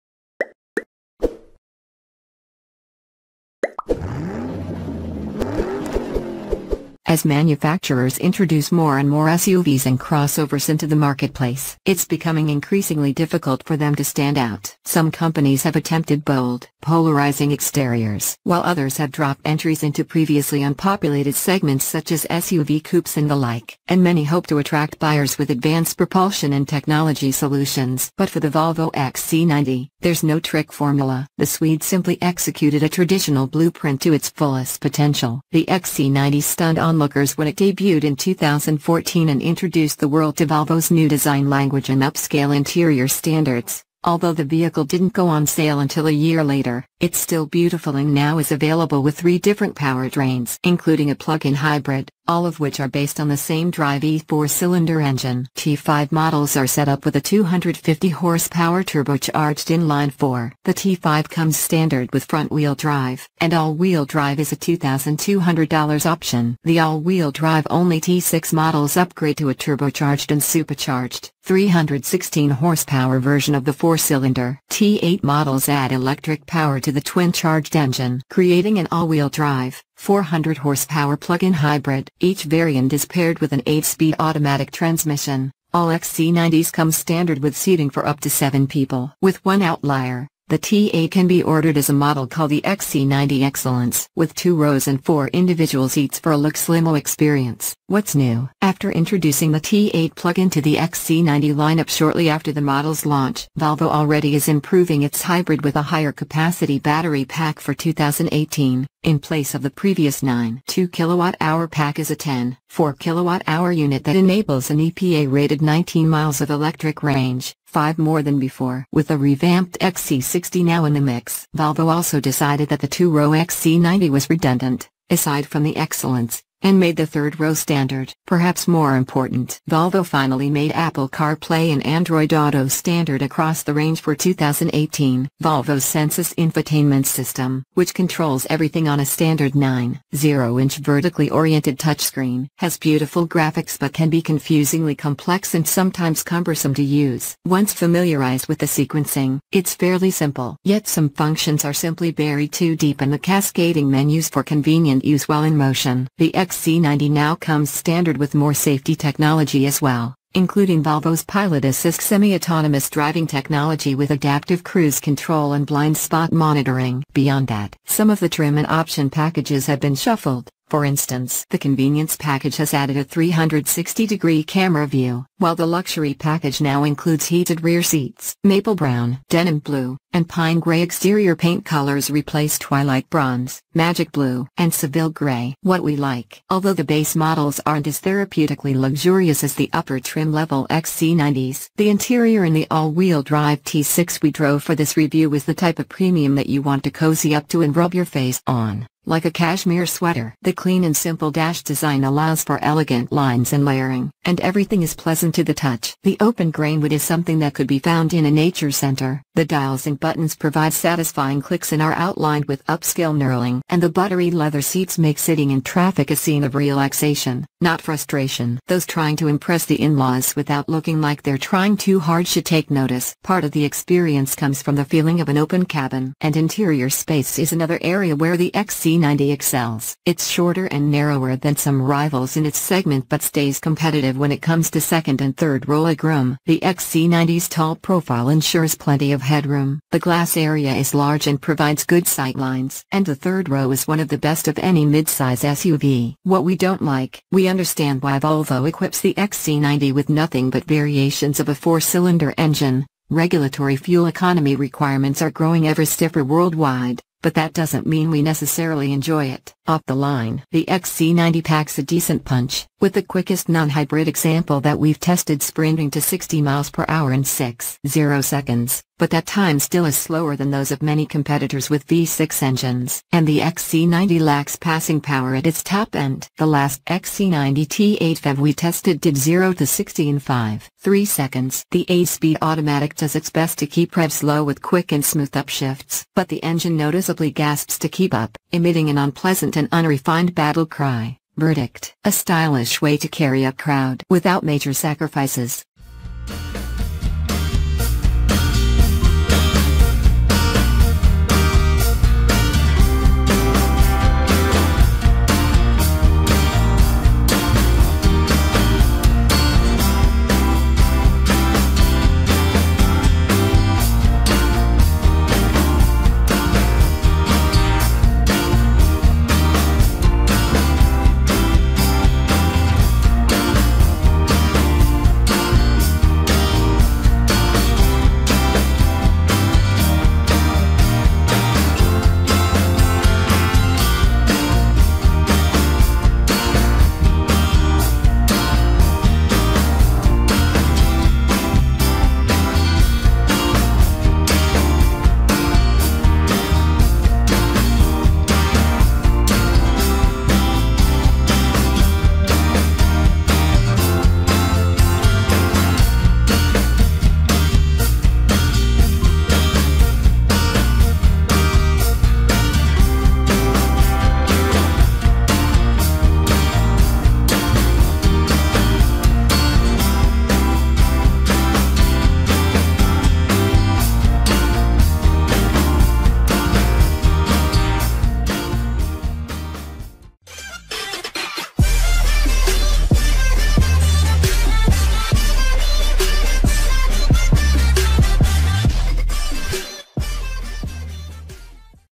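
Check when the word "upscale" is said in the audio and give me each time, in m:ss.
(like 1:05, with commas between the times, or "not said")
0:42, 3:32.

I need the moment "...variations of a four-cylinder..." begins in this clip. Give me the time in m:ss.
4:10.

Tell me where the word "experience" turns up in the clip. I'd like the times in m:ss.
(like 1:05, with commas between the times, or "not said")
1:36, 3:43.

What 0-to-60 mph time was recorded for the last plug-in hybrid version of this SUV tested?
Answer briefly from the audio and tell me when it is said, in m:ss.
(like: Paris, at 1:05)
5.3 seconds, at 4:40.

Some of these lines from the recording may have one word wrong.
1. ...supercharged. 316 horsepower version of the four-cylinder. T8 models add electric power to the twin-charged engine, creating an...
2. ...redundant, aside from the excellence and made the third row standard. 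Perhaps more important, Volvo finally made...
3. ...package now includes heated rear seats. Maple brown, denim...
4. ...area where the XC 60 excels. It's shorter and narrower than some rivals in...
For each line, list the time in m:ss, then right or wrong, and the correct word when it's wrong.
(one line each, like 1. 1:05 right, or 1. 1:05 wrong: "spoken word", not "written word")
1. 1:10 right
2. 2:04 right
3. 2:56 right
4. 3:47 wrong: "90", not "60".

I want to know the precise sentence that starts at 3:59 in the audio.
The glass area is large and provides good sightlines.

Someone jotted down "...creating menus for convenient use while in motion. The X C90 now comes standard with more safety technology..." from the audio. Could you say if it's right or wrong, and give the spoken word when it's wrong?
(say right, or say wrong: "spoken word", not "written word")
wrong: "cascading", not "creating".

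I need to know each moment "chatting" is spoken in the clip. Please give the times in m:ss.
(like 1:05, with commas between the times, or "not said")
not said.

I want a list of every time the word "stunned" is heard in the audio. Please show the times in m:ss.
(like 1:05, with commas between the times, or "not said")
0:36.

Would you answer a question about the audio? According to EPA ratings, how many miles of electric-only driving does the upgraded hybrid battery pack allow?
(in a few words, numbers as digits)
19 miles.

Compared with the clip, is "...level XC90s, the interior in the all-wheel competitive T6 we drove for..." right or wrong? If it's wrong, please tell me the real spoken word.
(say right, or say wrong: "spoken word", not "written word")
wrong: "drive", not "competitive".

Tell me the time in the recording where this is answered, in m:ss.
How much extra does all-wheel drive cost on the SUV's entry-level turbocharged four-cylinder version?
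1:04.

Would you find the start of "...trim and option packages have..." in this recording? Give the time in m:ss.
2:48.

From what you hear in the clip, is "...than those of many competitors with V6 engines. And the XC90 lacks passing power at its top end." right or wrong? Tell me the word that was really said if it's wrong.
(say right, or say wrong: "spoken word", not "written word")
right.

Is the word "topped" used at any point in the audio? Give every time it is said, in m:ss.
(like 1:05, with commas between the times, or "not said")
not said.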